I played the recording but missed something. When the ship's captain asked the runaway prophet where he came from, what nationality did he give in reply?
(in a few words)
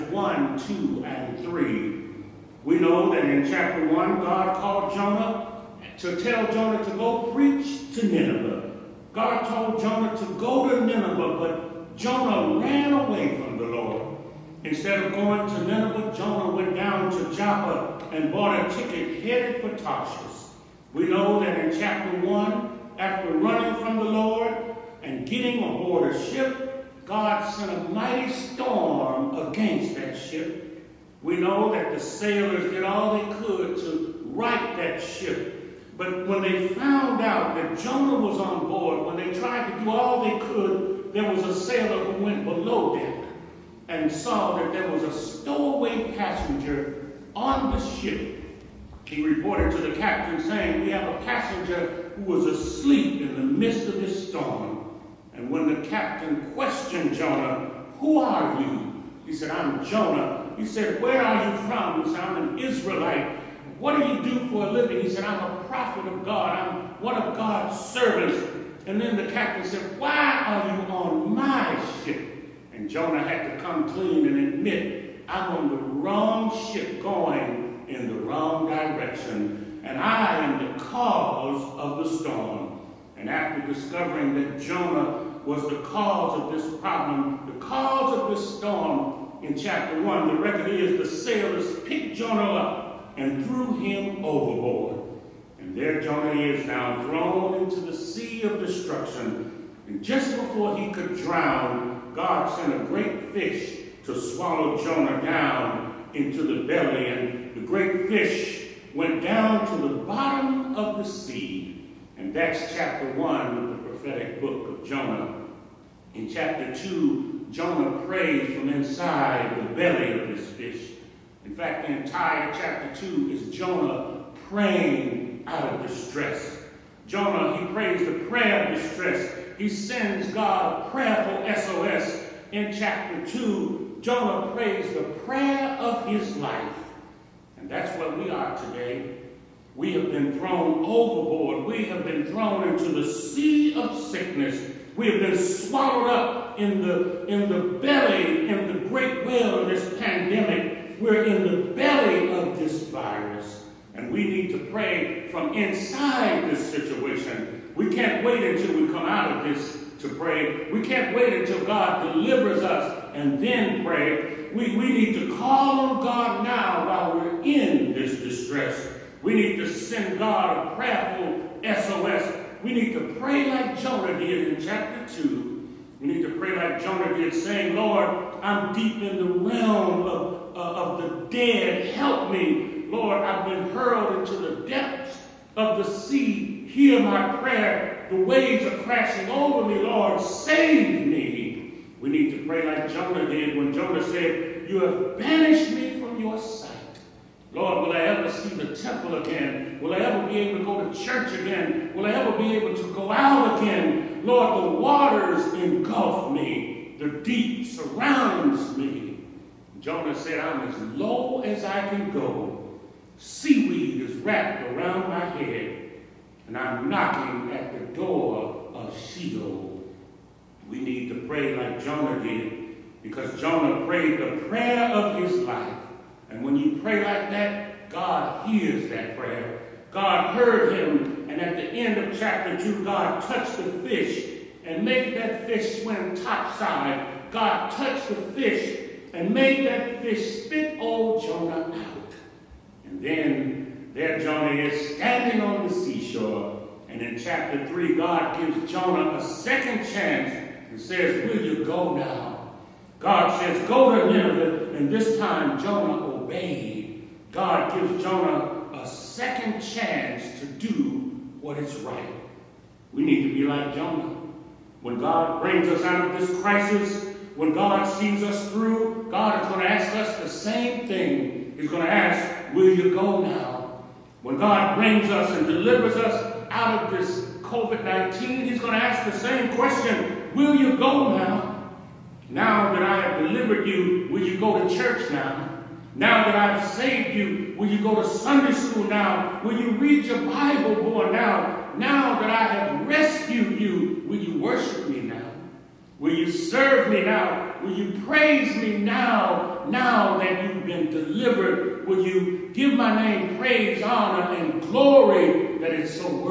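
Israelite.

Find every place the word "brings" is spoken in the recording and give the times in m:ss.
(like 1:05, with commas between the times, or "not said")
4:25, 4:34.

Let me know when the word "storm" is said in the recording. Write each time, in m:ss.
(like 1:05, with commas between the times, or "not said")
0:28, 0:54, 1:22, 1:28.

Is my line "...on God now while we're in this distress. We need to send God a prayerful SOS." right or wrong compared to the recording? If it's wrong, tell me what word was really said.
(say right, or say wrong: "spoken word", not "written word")
right.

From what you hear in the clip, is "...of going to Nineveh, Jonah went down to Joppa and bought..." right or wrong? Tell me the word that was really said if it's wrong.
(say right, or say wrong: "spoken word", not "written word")
right.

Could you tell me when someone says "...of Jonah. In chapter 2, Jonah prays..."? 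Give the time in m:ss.
1:54.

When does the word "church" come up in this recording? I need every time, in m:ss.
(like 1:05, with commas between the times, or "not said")
3:21, 4:44.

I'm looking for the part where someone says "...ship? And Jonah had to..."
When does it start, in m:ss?
1:12.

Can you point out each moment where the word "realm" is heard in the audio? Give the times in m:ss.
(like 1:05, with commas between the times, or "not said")
2:59.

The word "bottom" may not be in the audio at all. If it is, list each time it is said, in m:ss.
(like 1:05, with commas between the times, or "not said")
1:49.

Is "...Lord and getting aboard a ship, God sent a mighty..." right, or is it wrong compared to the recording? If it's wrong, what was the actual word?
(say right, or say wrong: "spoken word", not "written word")
right.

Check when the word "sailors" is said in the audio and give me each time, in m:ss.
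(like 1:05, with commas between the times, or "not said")
0:31, 0:41, 1:31.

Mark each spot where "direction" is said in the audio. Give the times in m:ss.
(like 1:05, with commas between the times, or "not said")
1:18.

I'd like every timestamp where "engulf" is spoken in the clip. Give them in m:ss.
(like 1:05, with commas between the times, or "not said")
3:25.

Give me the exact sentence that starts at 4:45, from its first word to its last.
Now that I've saved you, will you go to Sunday school now?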